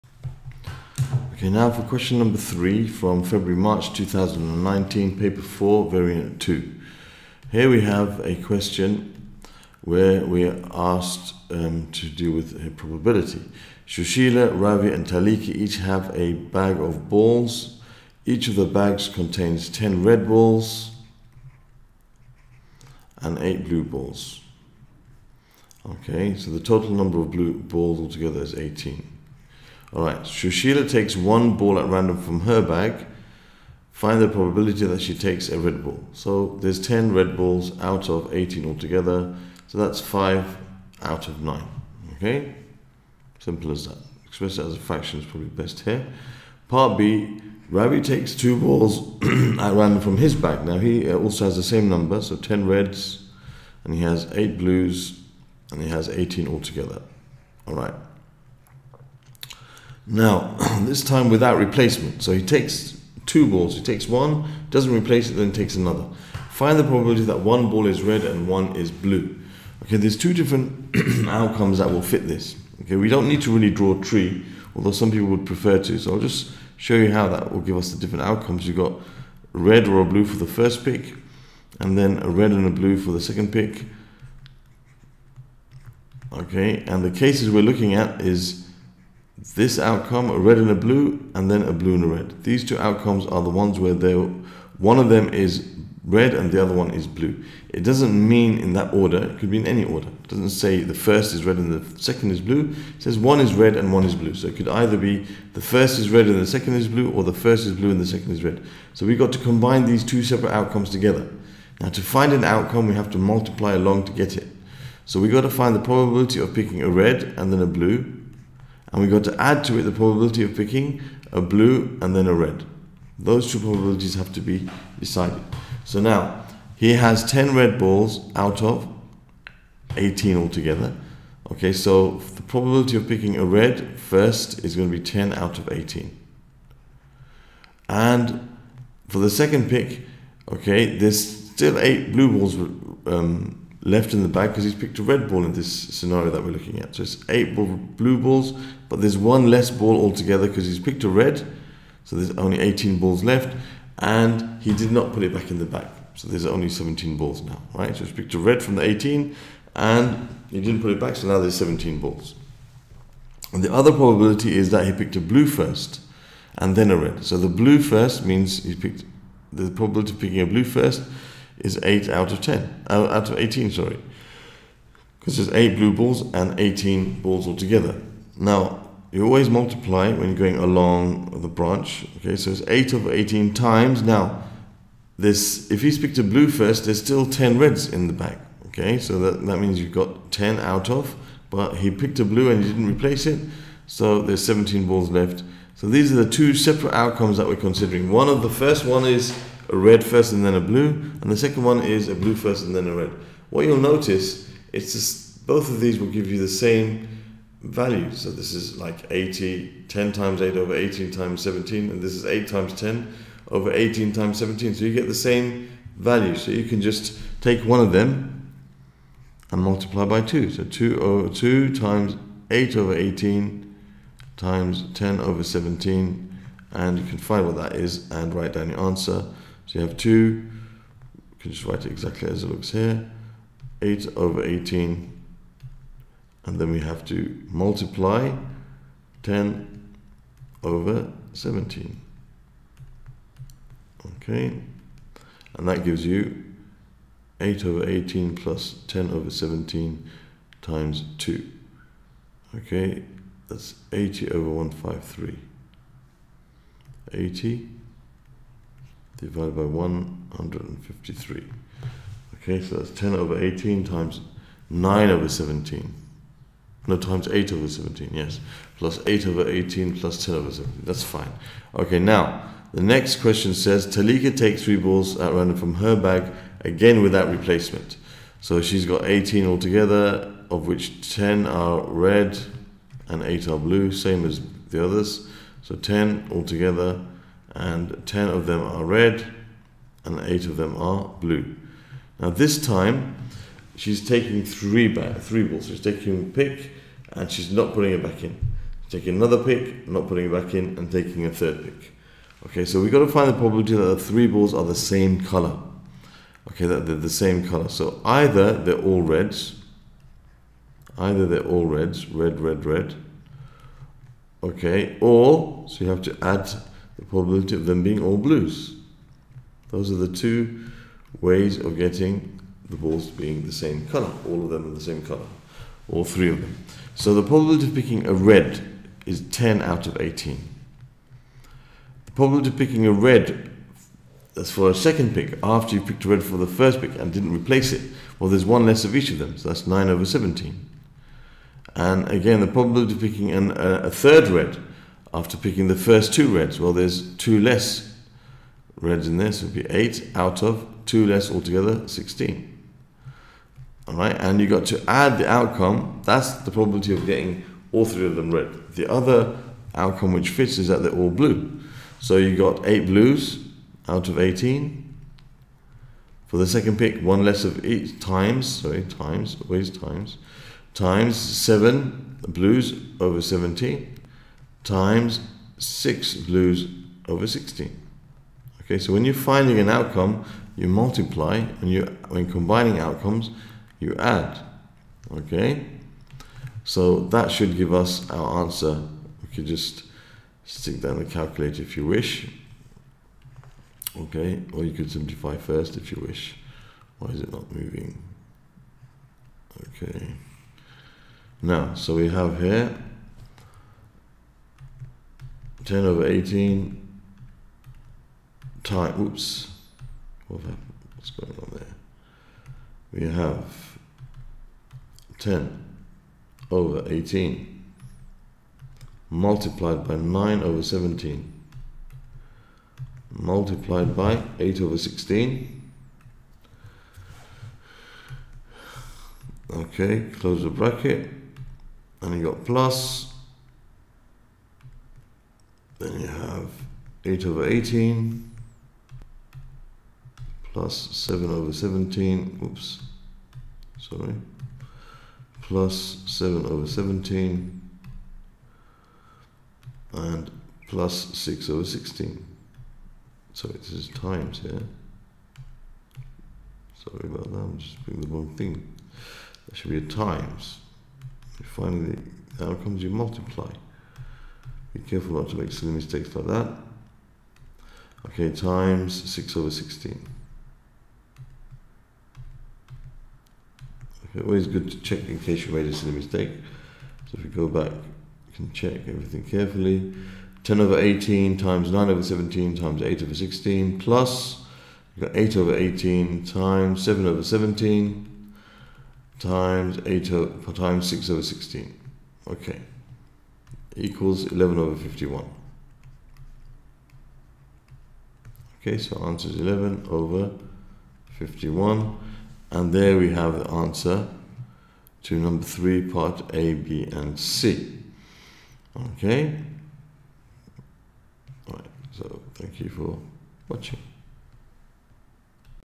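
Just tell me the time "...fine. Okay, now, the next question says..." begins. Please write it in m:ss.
4:31.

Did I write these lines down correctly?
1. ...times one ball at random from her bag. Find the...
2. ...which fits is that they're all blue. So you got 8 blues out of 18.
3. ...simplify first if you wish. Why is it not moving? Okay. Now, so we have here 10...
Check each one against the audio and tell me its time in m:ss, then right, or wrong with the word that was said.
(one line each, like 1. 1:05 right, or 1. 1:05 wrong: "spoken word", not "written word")
1. 0:30 wrong: "takes", not "times"
2. 6:00 right
3. 6:34 right.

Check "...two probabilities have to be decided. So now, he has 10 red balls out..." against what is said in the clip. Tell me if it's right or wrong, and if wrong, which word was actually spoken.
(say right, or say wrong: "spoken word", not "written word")
right.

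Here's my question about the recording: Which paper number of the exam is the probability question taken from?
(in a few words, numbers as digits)
4.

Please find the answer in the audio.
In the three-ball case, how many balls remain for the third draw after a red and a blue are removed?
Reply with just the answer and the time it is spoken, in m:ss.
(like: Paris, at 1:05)
16, at 6:17.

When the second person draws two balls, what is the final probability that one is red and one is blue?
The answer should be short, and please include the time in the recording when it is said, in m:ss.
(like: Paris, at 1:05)
80/153, at 4:13.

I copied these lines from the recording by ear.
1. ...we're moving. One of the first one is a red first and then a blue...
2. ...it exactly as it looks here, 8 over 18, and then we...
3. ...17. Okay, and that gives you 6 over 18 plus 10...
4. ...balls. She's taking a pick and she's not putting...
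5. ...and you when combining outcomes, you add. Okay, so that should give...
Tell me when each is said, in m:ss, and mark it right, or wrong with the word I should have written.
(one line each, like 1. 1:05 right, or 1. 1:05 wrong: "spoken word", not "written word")
1. 3:17 wrong: "considering", not "moving"
2. 3:51 right
3. 4:01 wrong: "8", not "6"
4. 4:55 right
5. 6:21 right.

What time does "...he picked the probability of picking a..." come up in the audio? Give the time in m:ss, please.
2:48.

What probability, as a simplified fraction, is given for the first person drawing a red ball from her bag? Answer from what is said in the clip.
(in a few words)
5/9.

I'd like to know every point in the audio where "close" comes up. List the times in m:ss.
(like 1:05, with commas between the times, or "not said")
7:10.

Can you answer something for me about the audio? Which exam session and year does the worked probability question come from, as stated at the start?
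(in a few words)
February March 2019.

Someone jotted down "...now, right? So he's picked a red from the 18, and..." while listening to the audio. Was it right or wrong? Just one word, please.
right.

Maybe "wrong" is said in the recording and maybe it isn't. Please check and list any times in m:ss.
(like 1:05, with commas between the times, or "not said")
7:38.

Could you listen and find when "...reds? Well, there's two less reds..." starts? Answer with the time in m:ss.
5:46.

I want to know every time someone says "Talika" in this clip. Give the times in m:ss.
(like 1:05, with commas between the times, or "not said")
0:15, 4:33.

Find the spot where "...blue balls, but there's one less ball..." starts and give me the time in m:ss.
2:27.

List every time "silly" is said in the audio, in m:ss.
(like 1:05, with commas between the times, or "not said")
7:45, 7:55.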